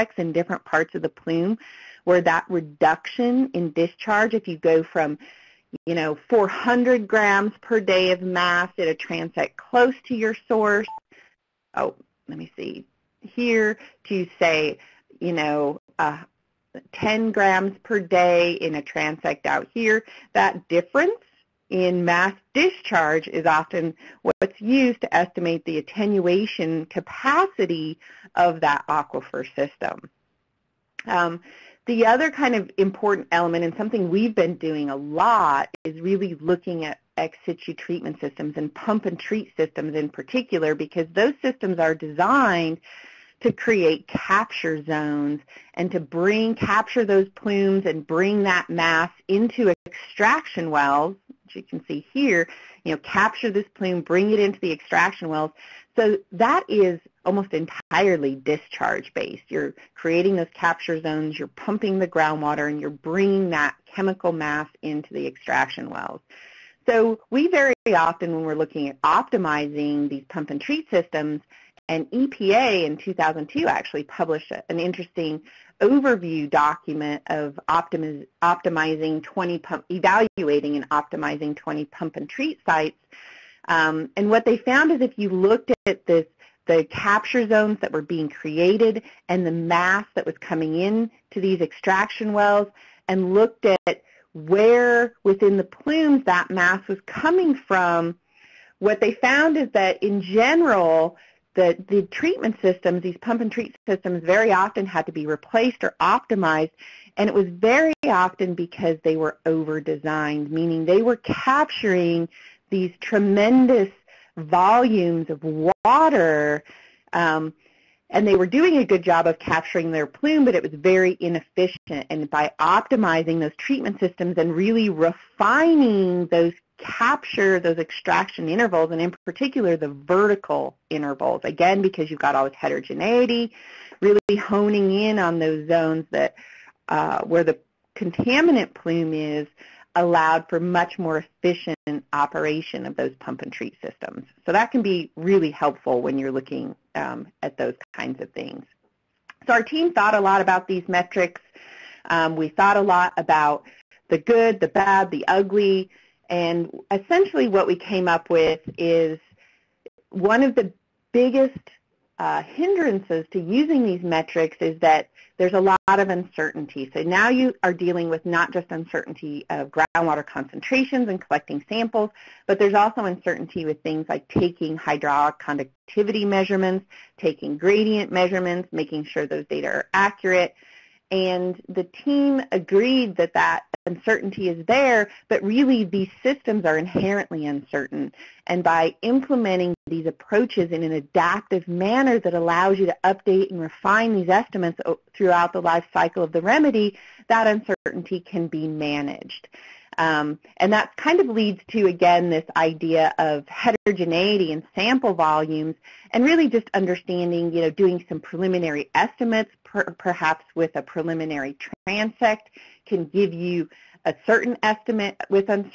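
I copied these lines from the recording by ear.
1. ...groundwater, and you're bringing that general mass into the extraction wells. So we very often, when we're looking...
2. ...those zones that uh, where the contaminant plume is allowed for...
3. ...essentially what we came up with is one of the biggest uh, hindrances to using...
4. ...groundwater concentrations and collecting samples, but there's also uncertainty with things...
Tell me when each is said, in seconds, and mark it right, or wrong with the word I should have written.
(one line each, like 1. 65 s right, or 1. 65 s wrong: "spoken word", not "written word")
1. 62 s wrong: "chemical", not "general"
2. 135 s right
3. 156 s right
4. 169 s right.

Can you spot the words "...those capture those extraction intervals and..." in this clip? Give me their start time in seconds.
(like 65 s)
126 s.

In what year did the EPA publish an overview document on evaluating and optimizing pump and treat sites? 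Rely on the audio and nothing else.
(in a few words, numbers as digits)
2002.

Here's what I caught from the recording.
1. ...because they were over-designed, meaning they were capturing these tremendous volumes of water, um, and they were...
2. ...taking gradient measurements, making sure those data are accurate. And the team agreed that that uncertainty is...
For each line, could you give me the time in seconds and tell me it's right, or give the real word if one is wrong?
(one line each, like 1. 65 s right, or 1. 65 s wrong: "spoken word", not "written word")
1. 108 s right
2. 177 s right.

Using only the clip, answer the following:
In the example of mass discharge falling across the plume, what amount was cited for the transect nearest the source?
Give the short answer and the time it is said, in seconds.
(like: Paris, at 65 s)
400 grams per day, at 6 s.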